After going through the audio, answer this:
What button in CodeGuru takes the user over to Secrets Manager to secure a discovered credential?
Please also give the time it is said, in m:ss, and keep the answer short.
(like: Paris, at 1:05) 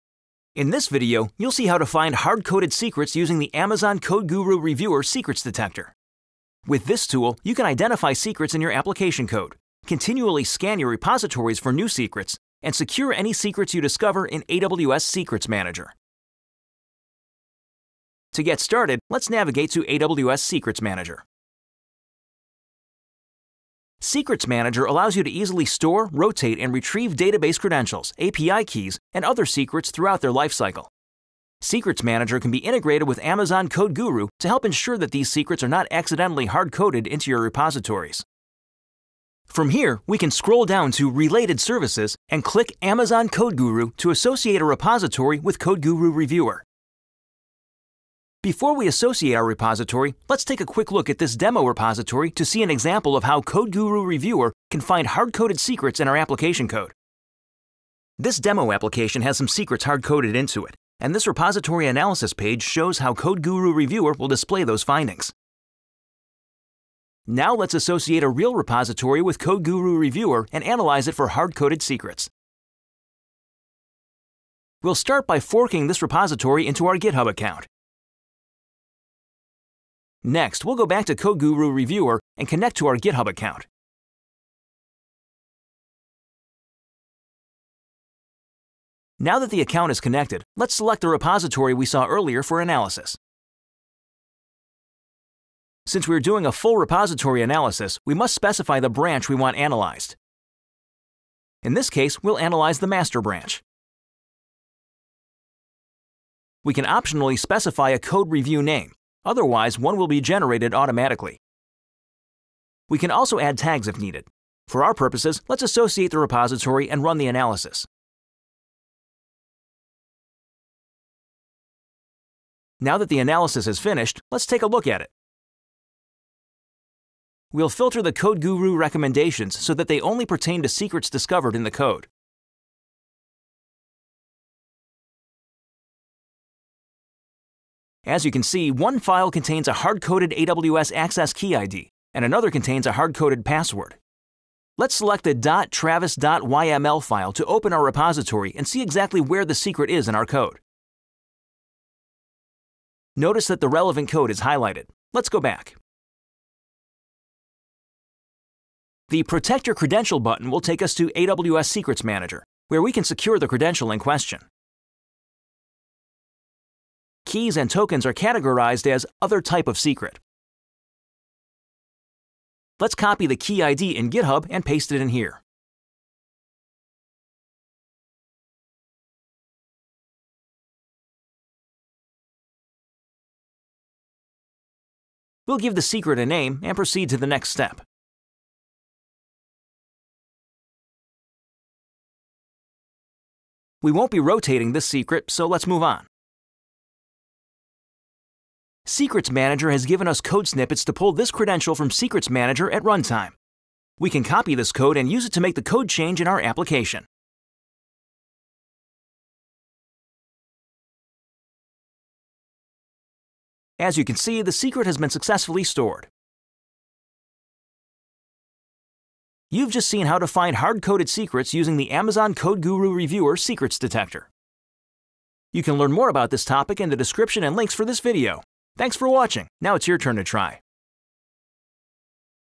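Protect Your Credential, at 2:39.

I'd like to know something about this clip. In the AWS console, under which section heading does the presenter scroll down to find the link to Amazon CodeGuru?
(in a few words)
Related Services.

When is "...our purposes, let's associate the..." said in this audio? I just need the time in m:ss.
1:54.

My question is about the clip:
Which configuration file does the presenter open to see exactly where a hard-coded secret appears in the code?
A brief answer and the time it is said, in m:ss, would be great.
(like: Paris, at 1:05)
.travis.yml, at 2:25.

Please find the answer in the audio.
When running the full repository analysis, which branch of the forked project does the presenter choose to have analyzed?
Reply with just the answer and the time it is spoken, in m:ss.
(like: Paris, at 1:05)
master, at 1:42.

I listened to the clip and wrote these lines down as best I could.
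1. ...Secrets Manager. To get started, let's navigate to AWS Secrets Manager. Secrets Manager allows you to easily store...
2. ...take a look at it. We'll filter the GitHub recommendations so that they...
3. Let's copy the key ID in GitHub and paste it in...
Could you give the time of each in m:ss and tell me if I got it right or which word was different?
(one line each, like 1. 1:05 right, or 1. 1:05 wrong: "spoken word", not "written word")
1. 0:15 right
2. 2:04 wrong: "CodeGuru", not "GitHub"
3. 2:52 right.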